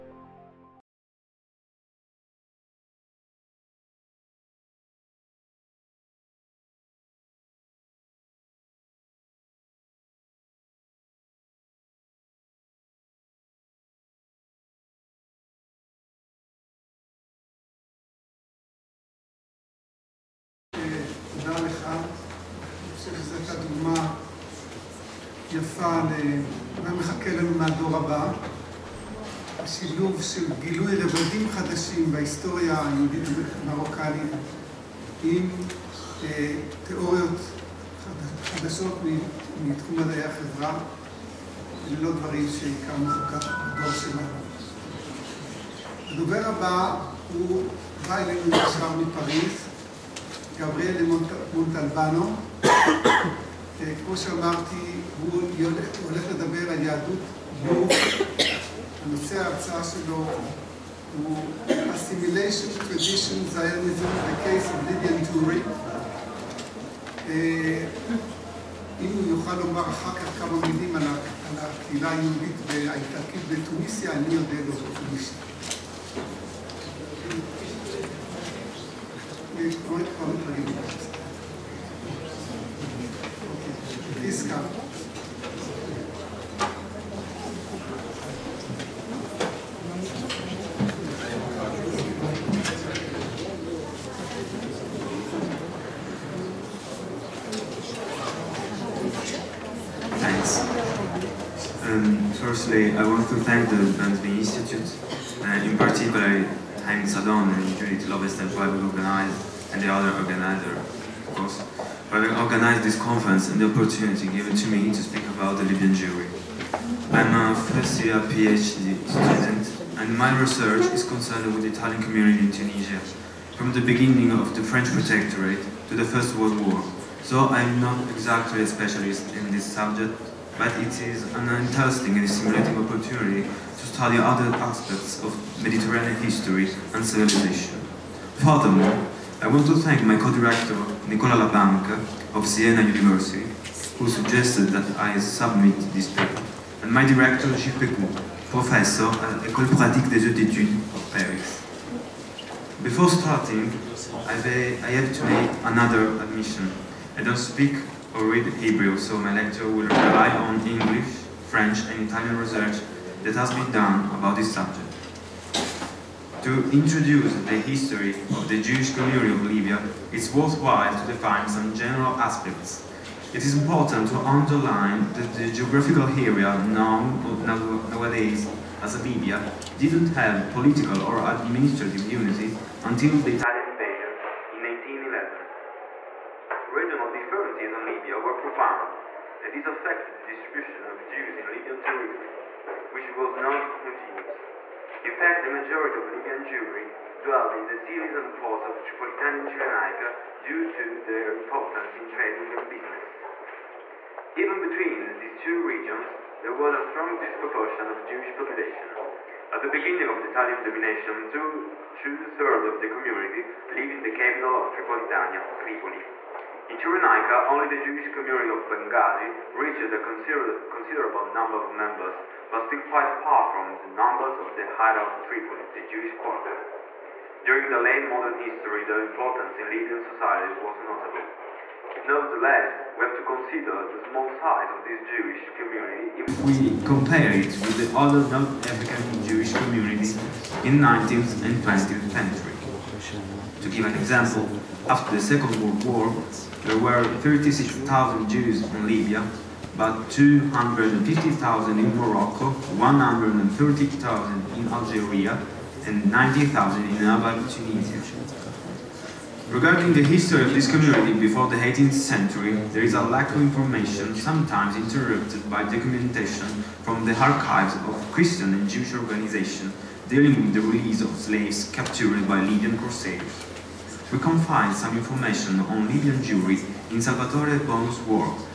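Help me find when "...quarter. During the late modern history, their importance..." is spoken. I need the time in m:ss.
3:46.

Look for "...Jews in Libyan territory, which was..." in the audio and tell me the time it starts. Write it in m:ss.
3:11.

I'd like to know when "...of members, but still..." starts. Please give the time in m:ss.
3:41.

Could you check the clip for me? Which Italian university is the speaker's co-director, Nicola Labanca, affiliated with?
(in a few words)
Siena University.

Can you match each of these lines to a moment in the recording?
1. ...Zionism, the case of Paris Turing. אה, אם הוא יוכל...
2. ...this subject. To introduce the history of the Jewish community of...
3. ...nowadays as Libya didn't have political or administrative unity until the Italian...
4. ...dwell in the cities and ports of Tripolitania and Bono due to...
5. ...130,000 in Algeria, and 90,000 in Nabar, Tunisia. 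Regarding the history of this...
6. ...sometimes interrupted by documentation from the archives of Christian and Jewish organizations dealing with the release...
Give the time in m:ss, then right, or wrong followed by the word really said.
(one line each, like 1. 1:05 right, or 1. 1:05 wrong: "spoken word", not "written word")
1. 1:03 wrong: "Lydian", not "Paris"
2. 2:44 right
3. 2:57 right
4. 3:17 wrong: "Cyrenaica", not "Bono"
5. 4:12 right
6. 4:24 right.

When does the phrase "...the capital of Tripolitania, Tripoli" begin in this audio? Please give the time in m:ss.
3:34.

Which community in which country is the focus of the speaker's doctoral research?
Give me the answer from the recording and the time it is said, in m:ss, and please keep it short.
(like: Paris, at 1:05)
Italian community in Tunisia, at 2:01.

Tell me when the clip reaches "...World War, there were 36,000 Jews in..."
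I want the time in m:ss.
4:05.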